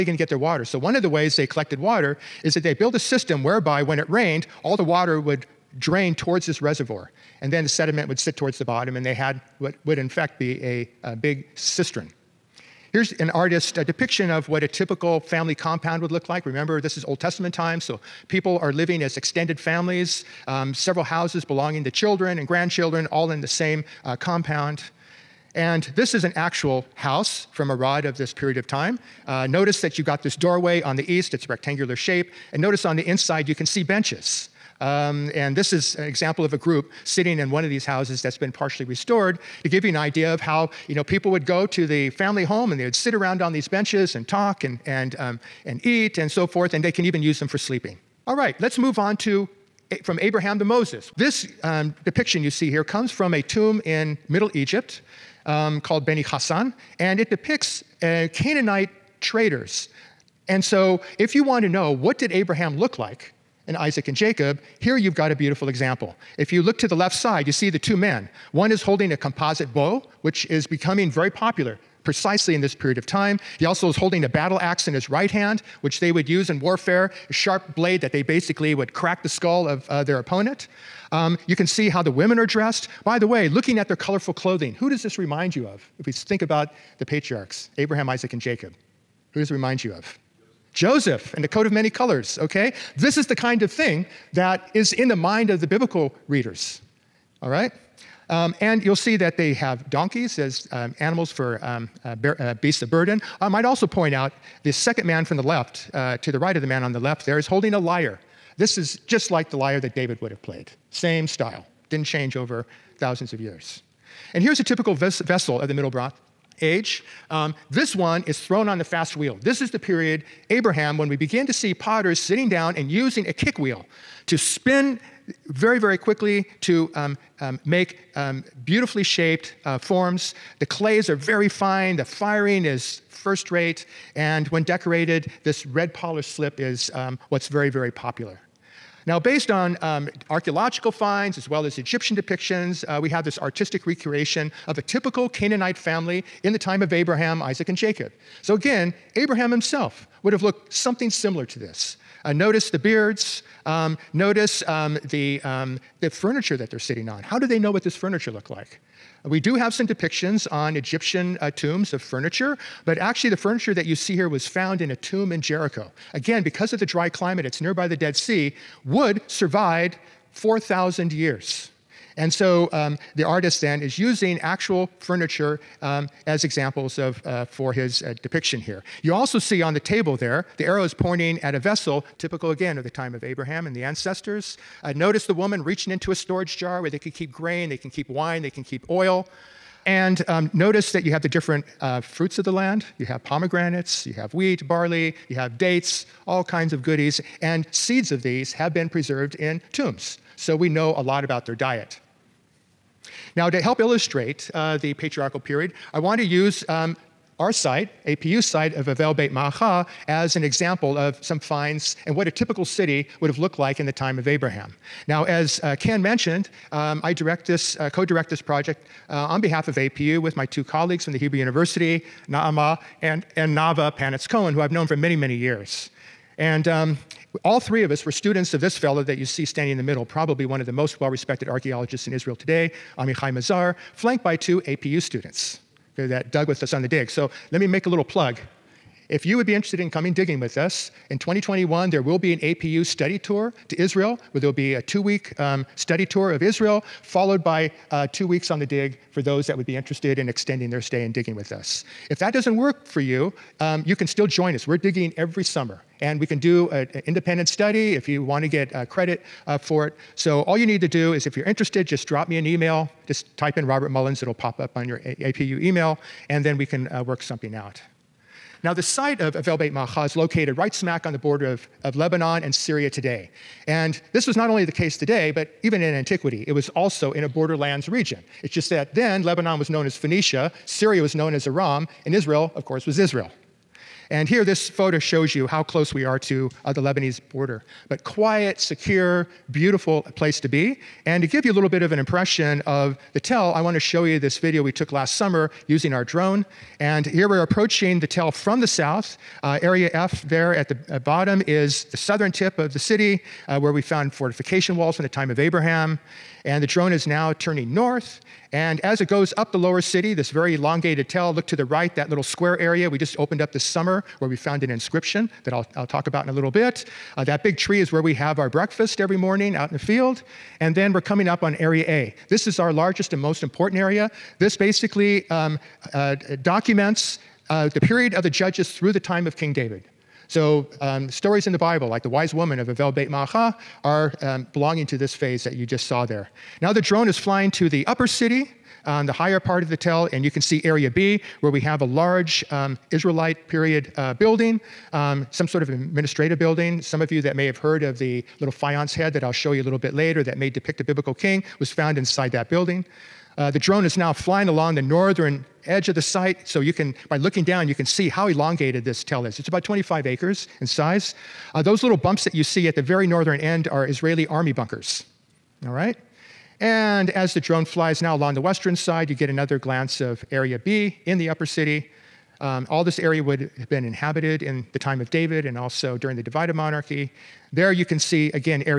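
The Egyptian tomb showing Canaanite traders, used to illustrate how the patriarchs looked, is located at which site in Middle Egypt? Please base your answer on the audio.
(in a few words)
Beni Hassan.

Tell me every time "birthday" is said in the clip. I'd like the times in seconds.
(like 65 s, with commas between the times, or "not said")
not said.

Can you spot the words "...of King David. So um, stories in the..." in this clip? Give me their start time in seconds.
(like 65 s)
329 s.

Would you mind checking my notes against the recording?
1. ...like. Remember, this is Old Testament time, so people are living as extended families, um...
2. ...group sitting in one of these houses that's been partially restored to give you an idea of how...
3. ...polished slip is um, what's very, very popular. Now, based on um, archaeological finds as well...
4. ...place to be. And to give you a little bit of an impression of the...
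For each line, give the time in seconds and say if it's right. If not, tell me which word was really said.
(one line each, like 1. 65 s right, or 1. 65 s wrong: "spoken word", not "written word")
1. 16 s right
2. 36 s right
3. 135 s right
4. 290 s right.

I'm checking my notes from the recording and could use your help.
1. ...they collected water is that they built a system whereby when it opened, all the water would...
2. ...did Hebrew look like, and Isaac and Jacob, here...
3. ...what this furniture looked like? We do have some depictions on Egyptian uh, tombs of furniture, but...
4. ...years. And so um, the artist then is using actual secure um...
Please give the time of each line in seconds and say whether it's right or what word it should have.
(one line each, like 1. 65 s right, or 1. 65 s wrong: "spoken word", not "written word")
1. 1 s wrong: "rained", not "opened"
2. 62 s wrong: "Abraham", not "Hebrew"
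3. 157 s right
4. 171 s wrong: "furniture", not "secure".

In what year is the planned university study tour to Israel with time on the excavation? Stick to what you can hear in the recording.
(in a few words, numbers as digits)
2021.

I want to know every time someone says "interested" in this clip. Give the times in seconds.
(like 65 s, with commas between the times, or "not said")
239 s, 249 s, 261 s.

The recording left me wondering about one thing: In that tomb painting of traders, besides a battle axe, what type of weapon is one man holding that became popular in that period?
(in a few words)
Composite bow.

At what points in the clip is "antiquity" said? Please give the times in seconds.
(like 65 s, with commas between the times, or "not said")
275 s.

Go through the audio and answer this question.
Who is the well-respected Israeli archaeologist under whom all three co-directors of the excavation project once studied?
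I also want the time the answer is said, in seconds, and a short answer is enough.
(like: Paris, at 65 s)
Amichai Mazar, at 232 s.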